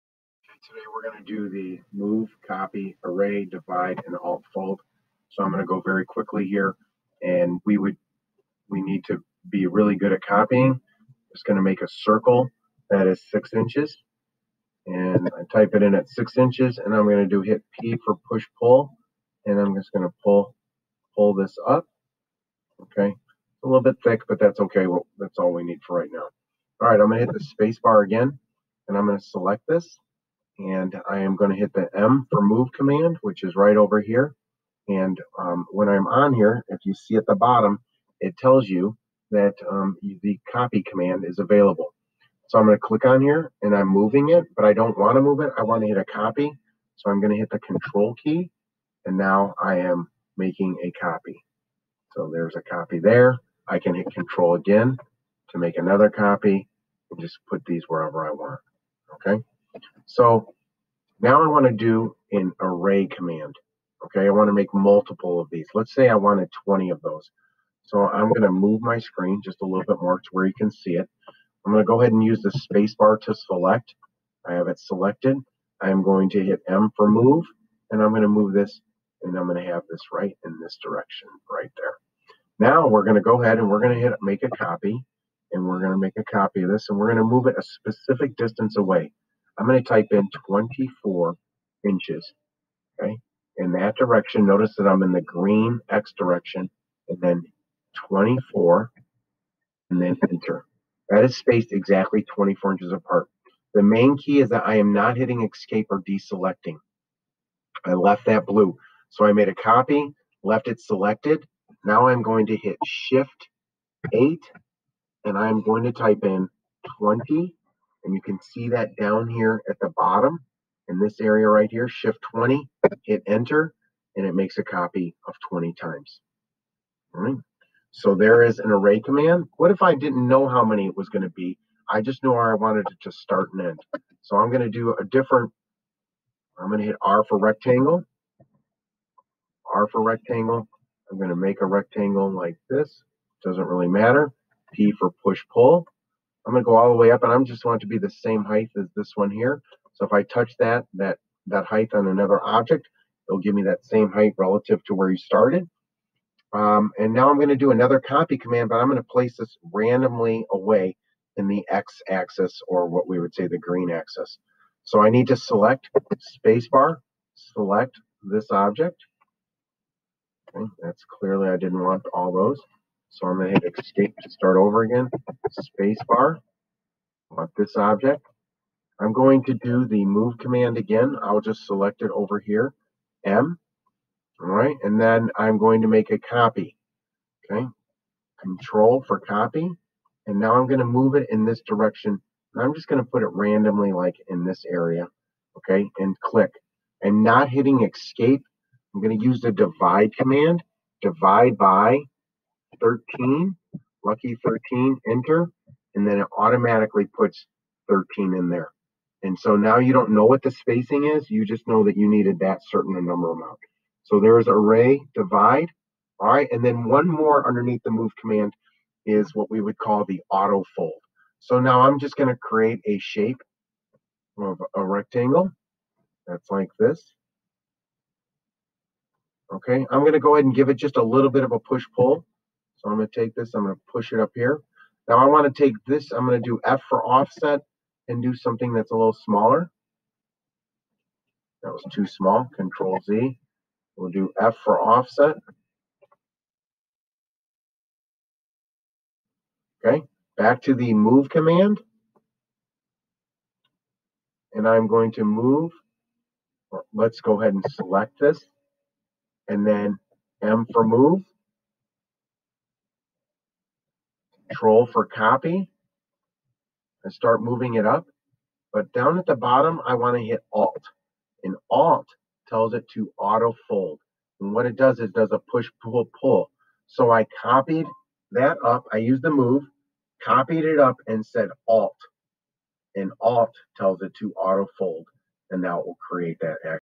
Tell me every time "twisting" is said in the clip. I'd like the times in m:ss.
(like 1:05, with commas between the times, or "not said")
not said.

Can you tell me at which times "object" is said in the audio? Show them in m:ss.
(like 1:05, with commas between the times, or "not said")
2:32, 2:48, 2:57.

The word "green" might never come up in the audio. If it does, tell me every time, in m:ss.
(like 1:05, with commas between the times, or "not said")
1:35, 2:43.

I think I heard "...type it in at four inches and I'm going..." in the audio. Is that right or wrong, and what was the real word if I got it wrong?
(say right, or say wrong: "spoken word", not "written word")
wrong: "six", not "four".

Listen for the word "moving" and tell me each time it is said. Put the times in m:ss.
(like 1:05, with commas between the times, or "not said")
0:43, 4:27.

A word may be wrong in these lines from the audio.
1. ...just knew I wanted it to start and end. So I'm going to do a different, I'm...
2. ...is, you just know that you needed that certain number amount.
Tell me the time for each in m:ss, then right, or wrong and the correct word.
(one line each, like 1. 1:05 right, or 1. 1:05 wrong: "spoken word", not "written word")
1. 2:12 right
2. 3:31 right.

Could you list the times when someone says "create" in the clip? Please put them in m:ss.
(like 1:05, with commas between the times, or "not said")
3:42, 4:46.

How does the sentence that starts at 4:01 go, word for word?
That was too small, Control Z.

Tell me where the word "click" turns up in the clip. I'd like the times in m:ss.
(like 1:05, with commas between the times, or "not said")
0:42, 3:16.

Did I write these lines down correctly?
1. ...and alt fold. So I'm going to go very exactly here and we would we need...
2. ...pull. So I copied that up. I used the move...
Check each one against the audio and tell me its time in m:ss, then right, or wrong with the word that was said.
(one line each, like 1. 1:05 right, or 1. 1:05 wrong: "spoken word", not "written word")
1. 0:04 wrong: "quickly", not "exactly"
2. 4:36 right.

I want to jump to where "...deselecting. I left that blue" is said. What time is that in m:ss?
1:46.